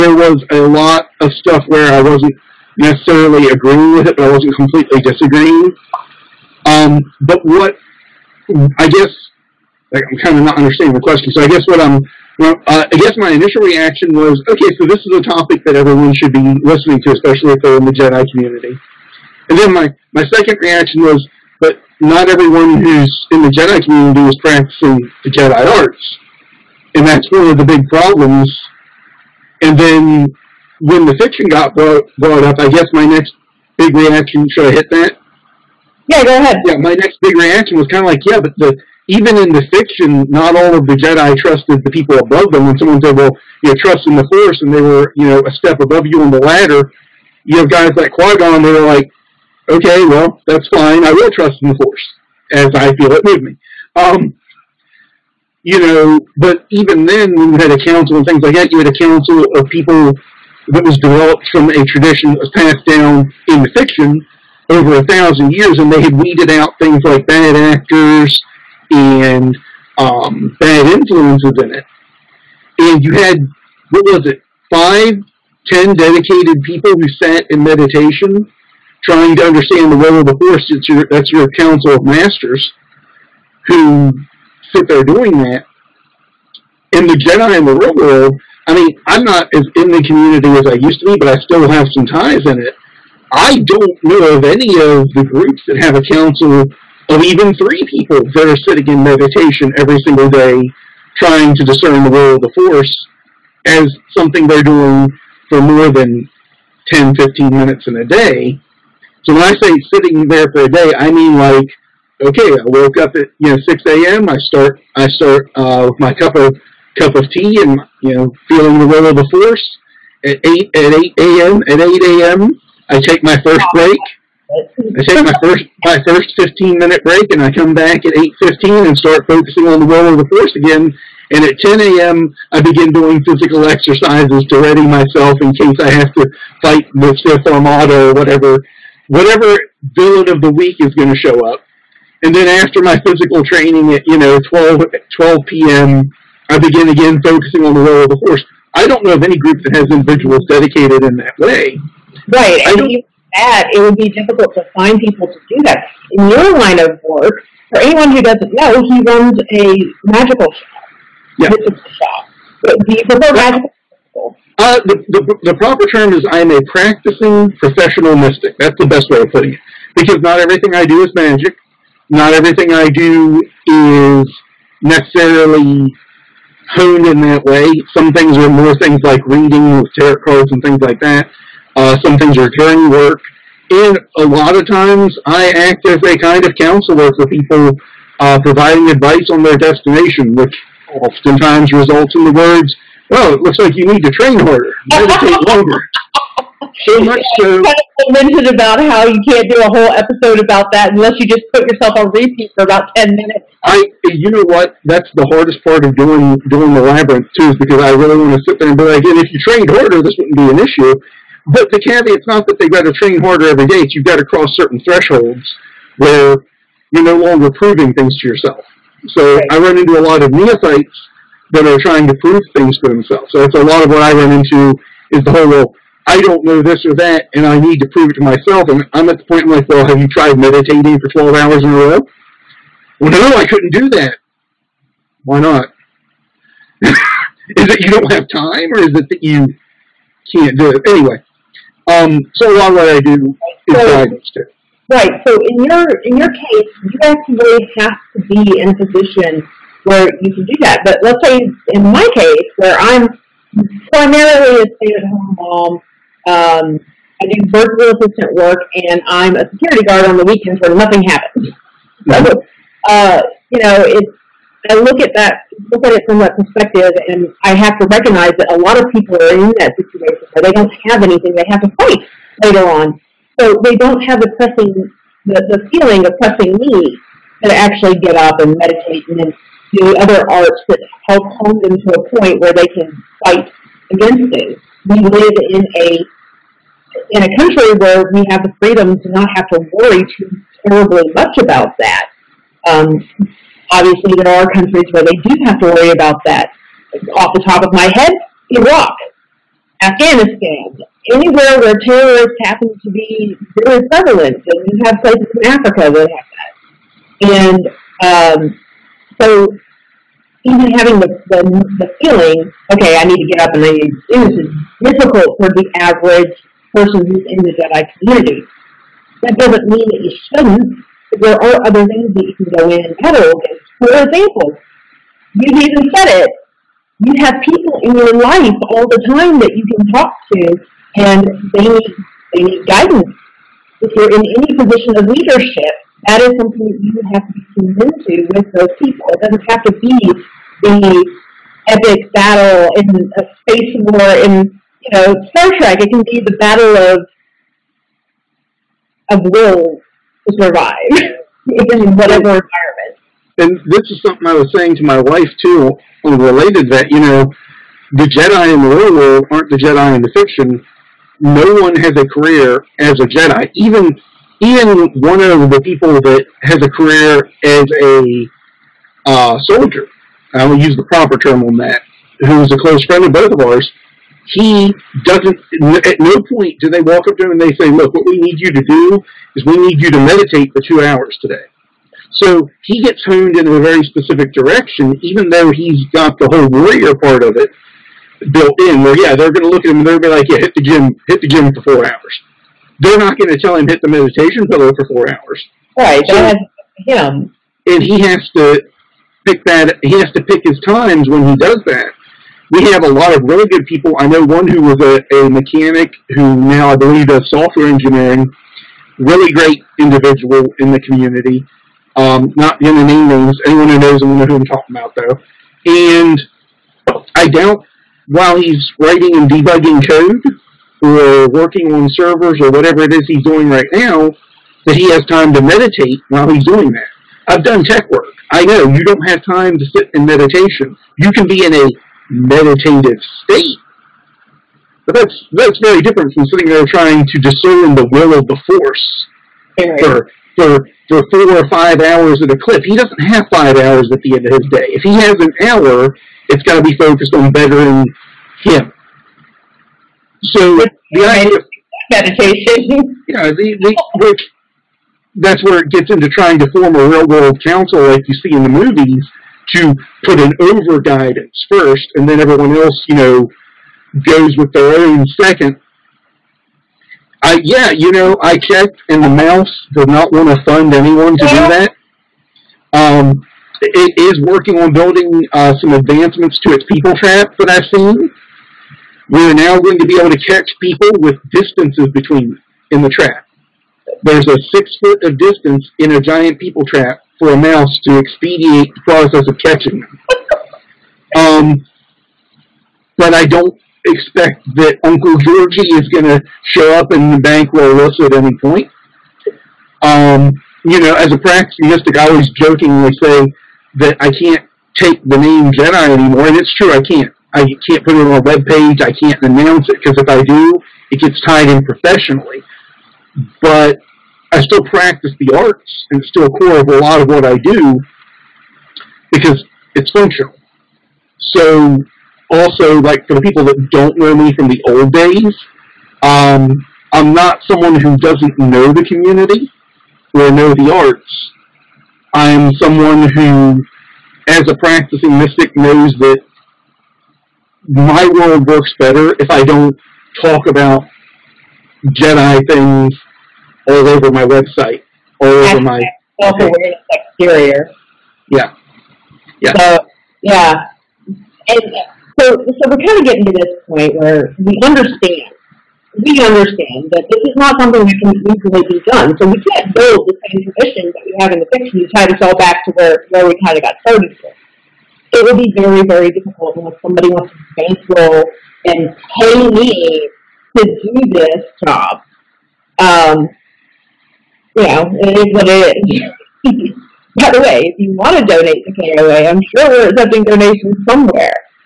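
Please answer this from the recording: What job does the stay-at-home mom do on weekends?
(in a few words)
security guard.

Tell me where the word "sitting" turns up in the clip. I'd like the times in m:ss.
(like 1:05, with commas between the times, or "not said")
1:38, 1:49, 7:16.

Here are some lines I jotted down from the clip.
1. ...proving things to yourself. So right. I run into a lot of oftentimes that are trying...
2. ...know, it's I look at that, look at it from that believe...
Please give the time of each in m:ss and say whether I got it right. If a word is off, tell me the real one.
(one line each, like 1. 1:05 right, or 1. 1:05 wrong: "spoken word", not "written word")
1. 3:37 wrong: "neophytes", not "oftentimes"
2. 4:23 wrong: "perspective", not "believe".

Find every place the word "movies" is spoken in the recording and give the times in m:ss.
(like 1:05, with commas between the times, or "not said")
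7:38.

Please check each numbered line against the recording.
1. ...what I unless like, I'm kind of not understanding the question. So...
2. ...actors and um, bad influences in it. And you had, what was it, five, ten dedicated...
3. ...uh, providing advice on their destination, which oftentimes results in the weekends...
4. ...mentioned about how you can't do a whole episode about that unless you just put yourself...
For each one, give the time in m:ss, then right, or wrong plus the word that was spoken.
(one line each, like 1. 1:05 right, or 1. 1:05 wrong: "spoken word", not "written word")
1. 0:07 wrong: "guess", not "unless"
2. 1:07 right
3. 3:08 wrong: "words", not "weekends"
4. 3:18 right.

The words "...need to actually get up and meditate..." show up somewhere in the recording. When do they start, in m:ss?
4:36.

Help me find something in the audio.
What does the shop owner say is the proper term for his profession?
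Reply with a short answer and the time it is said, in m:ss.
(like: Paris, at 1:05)
practicing professional mystic, at 2:46.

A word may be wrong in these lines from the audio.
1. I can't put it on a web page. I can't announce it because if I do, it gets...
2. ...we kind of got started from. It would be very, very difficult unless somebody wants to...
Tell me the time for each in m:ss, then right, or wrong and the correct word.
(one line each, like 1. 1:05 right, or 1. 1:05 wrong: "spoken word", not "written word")
1. 8:27 right
2. 9:23 right.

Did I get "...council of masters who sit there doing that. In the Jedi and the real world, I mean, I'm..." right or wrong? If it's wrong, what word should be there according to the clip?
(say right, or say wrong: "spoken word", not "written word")
right.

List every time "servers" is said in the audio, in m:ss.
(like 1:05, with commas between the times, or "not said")
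7:01.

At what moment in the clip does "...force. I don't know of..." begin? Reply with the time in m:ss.
2:28.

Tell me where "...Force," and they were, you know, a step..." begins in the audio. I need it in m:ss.
0:44.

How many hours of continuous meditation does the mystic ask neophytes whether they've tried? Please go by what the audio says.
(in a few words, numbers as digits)
12.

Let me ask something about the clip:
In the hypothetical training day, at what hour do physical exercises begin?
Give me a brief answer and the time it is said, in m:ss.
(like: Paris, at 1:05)
10 a.m., at 2:11.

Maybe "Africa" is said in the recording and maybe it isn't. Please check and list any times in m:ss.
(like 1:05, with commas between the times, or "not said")
5:05.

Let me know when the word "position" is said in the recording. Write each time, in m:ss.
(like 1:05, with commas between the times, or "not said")
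4:08, 5:34.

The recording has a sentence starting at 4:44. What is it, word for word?
We live in a in a country where we have the freedom to not have to worry too terribly much about that.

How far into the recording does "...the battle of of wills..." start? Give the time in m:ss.
5:46.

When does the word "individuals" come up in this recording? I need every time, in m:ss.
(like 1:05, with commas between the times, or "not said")
2:29, 6:49.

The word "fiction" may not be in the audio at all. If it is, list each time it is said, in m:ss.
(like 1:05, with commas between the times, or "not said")
0:31, 0:39, 1:03, 6:00, 9:21.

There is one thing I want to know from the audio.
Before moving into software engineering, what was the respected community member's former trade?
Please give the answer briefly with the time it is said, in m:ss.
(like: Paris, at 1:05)
mechanic, at 6:45.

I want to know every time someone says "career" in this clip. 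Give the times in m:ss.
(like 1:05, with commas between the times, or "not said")
6:02, 6:06.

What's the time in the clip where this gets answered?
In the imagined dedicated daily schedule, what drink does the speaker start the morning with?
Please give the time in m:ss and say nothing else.
1:57.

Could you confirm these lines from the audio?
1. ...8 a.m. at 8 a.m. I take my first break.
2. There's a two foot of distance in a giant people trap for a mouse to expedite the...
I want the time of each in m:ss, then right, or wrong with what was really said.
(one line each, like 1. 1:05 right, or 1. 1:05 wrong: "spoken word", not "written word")
1. 2:01 right
2. 8:04 wrong: "six", not "two".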